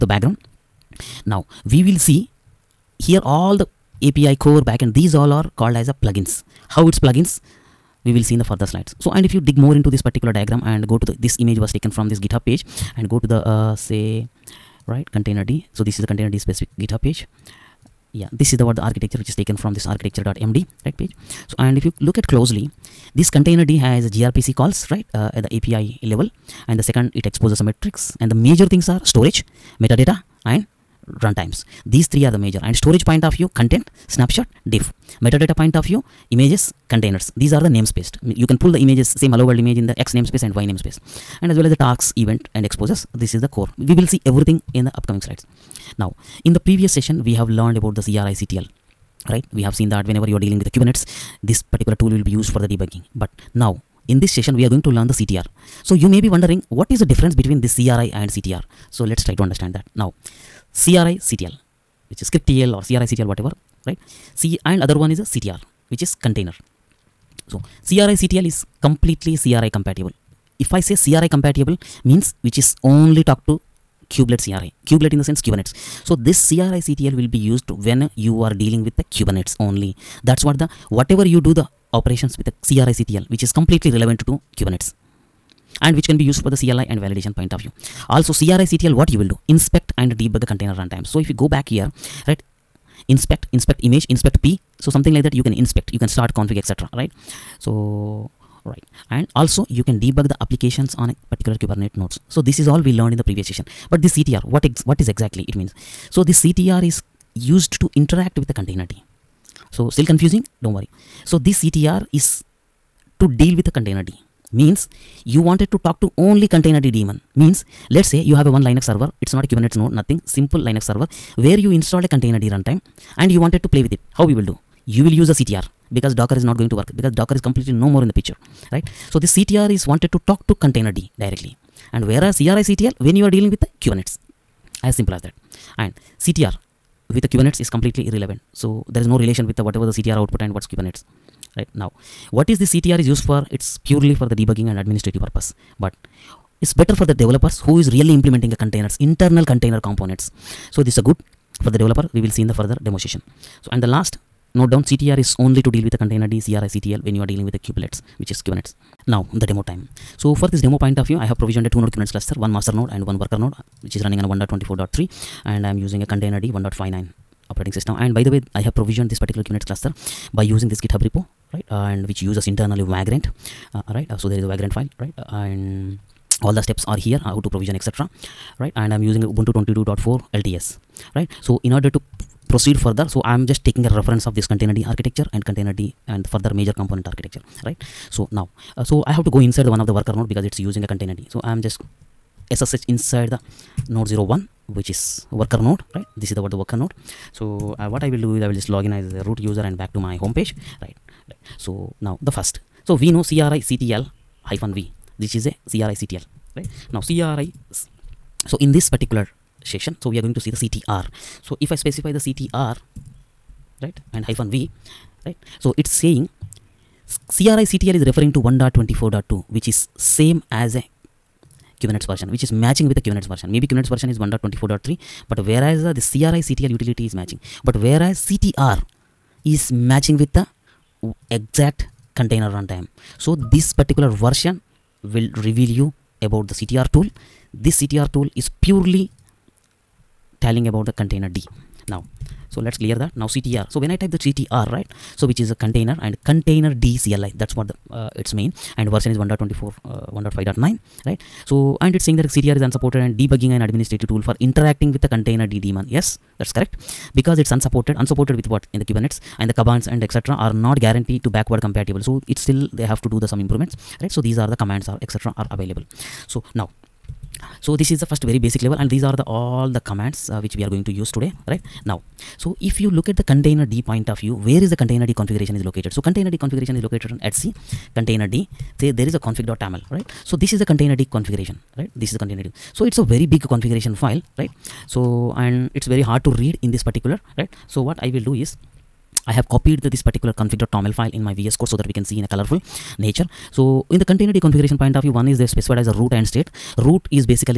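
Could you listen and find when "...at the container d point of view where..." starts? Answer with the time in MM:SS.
04:33.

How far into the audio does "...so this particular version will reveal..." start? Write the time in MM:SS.
03:53.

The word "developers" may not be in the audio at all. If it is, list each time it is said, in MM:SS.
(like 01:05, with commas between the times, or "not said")
02:27, 02:31.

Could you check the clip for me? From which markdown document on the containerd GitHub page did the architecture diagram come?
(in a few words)
architecture.md.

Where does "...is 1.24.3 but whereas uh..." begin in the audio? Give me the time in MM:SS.
03:44.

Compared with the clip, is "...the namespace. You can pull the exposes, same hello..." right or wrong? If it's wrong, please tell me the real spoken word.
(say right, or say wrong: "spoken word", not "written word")
wrong: "images", not "exposes".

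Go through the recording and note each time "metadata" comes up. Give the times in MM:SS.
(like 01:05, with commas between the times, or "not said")
00:29, 00:35.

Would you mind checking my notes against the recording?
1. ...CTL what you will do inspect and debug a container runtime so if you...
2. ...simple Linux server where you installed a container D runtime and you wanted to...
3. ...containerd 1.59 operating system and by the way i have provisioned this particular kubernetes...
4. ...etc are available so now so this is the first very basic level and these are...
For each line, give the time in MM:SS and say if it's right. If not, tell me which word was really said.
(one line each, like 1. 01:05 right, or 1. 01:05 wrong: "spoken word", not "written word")
1. 01:28 right
2. 02:00 right
3. 02:46 right
4. 04:25 right.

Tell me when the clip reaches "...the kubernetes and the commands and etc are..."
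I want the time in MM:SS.
04:18.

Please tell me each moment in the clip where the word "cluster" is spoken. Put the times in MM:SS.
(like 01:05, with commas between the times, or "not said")
02:42, 02:49.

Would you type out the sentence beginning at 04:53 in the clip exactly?
So in the container d configuration point of view, one is they specified as a root and state.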